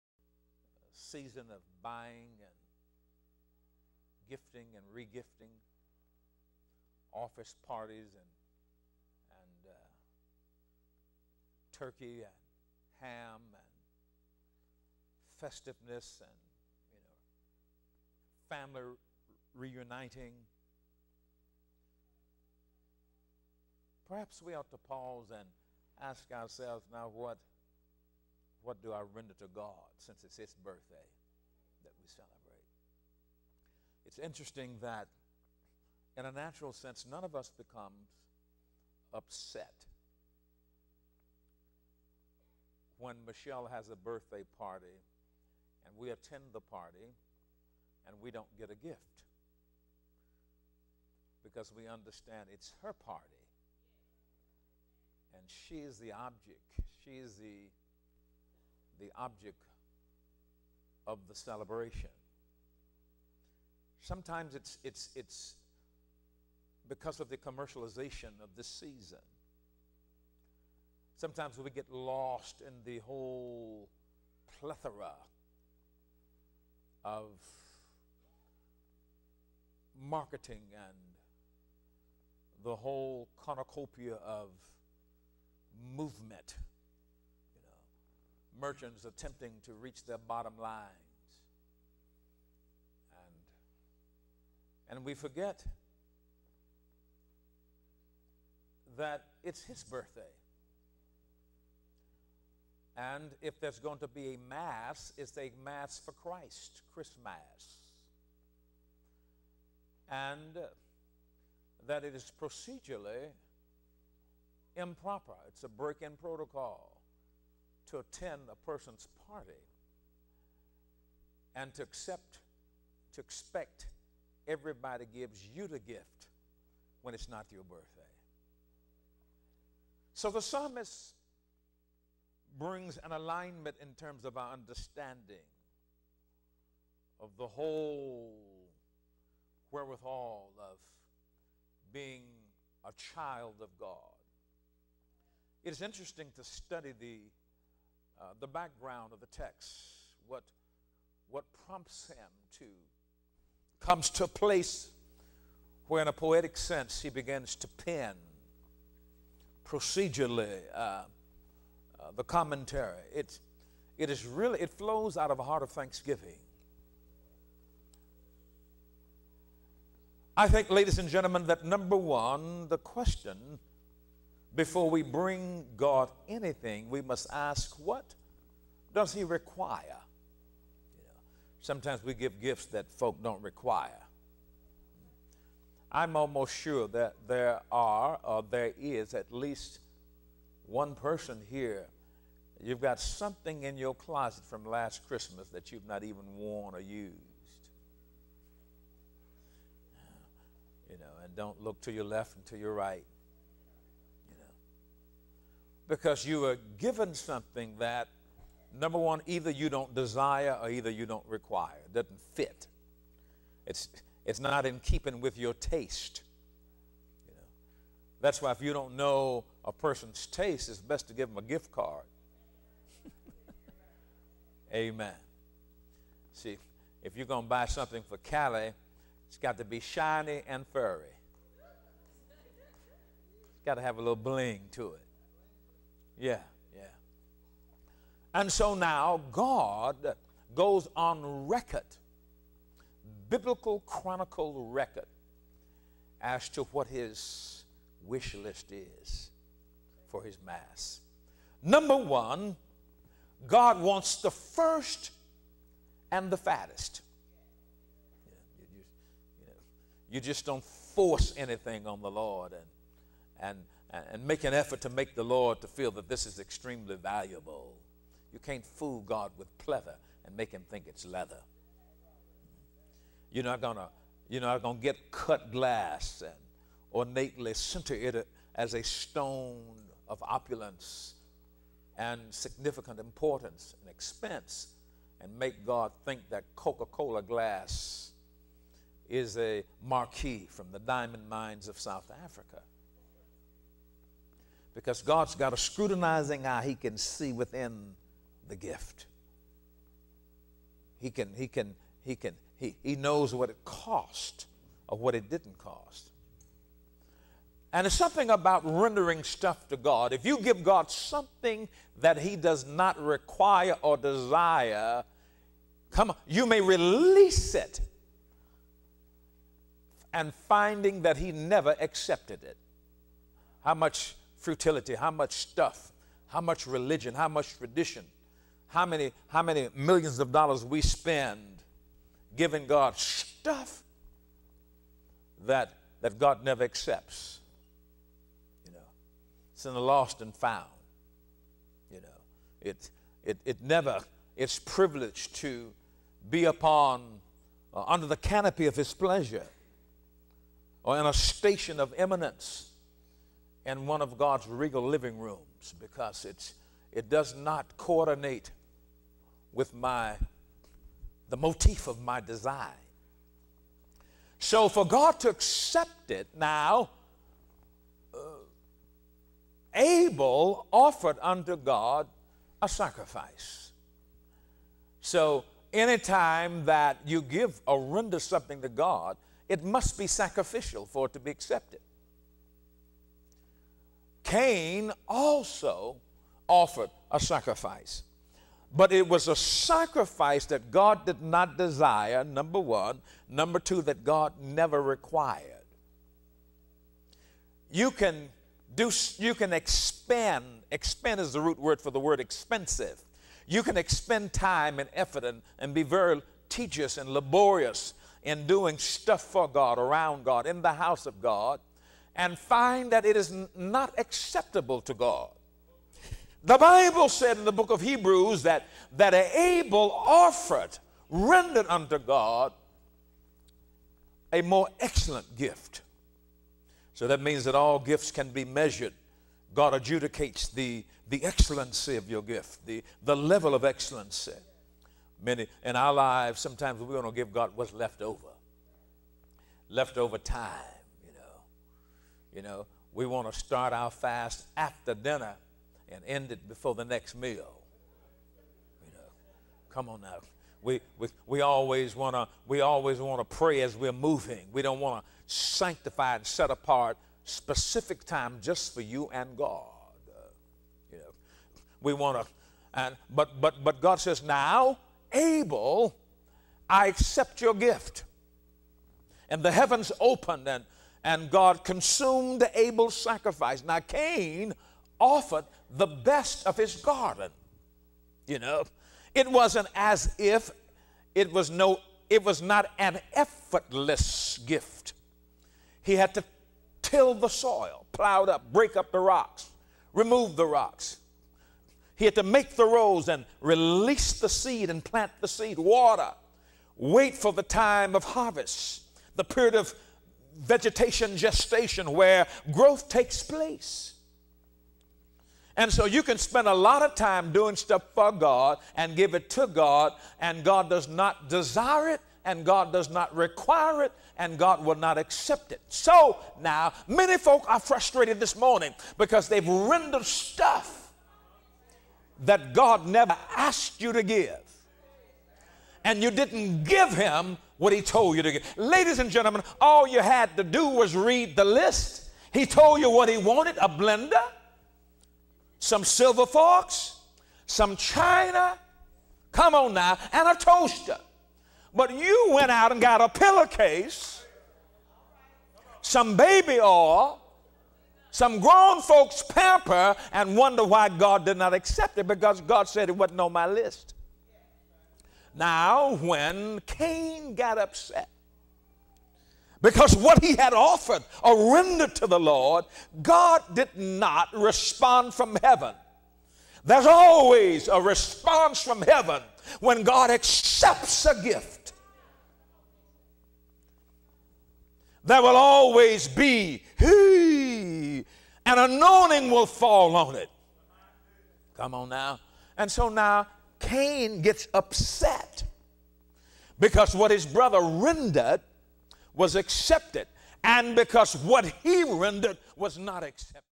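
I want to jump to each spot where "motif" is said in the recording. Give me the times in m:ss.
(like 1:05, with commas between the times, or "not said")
6:01.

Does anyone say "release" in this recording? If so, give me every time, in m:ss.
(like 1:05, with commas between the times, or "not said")
5:16, 8:13.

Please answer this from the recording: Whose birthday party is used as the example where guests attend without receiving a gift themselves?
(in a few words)
Michelle.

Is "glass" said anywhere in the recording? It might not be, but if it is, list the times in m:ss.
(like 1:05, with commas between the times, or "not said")
4:35, 4:47.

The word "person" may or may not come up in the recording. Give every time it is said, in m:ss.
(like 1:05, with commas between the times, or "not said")
1:58, 3:10, 3:39.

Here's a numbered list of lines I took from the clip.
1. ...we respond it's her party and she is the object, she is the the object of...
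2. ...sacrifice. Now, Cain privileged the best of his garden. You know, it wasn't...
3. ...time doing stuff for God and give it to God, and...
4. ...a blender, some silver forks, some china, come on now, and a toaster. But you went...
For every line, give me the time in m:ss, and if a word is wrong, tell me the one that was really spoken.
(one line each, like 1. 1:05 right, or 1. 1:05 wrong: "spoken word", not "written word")
1. 0:51 wrong: "understand", not "respond"
2. 7:52 wrong: "offered", not "privileged"
3. 8:26 right
4. 8:53 right.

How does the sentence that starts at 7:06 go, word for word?
So that means that all gifts can be measured.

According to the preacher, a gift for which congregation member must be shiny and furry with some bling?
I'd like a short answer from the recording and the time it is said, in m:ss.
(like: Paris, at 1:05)
Callie, at 3:48.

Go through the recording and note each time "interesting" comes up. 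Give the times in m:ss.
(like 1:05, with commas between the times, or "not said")
0:34, 2:25.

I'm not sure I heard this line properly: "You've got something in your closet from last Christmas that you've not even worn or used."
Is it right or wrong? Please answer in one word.
right.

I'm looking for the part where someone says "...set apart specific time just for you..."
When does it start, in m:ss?
7:36.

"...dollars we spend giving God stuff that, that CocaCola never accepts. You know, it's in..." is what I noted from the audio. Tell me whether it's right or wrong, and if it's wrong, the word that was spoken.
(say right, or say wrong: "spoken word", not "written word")
wrong: "God", not "CocaCola".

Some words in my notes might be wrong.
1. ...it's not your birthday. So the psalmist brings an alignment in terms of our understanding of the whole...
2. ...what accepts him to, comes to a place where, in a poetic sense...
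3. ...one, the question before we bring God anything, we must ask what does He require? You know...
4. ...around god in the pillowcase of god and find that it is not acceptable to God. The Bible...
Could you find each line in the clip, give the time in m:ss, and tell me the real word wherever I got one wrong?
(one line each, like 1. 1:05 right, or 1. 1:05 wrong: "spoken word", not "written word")
1. 2:07 right
2. 2:31 wrong: "prompts", not "accepts"
3. 2:51 right
4. 6:49 wrong: "house", not "pillowcase".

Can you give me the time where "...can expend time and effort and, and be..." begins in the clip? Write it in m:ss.
6:43.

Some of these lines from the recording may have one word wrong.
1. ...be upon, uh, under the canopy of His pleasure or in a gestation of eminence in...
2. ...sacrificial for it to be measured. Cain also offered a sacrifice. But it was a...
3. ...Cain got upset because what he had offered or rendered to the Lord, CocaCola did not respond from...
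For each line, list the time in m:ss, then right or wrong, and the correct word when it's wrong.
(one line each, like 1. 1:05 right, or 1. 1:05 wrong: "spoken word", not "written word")
1. 5:46 wrong: "station", not "gestation"
2. 6:20 wrong: "accepted", not "measured"
3. 9:16 wrong: "God", not "CocaCola".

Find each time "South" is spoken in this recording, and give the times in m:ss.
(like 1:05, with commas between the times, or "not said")
4:51.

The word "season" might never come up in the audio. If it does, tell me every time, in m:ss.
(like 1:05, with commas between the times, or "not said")
0:01, 1:08.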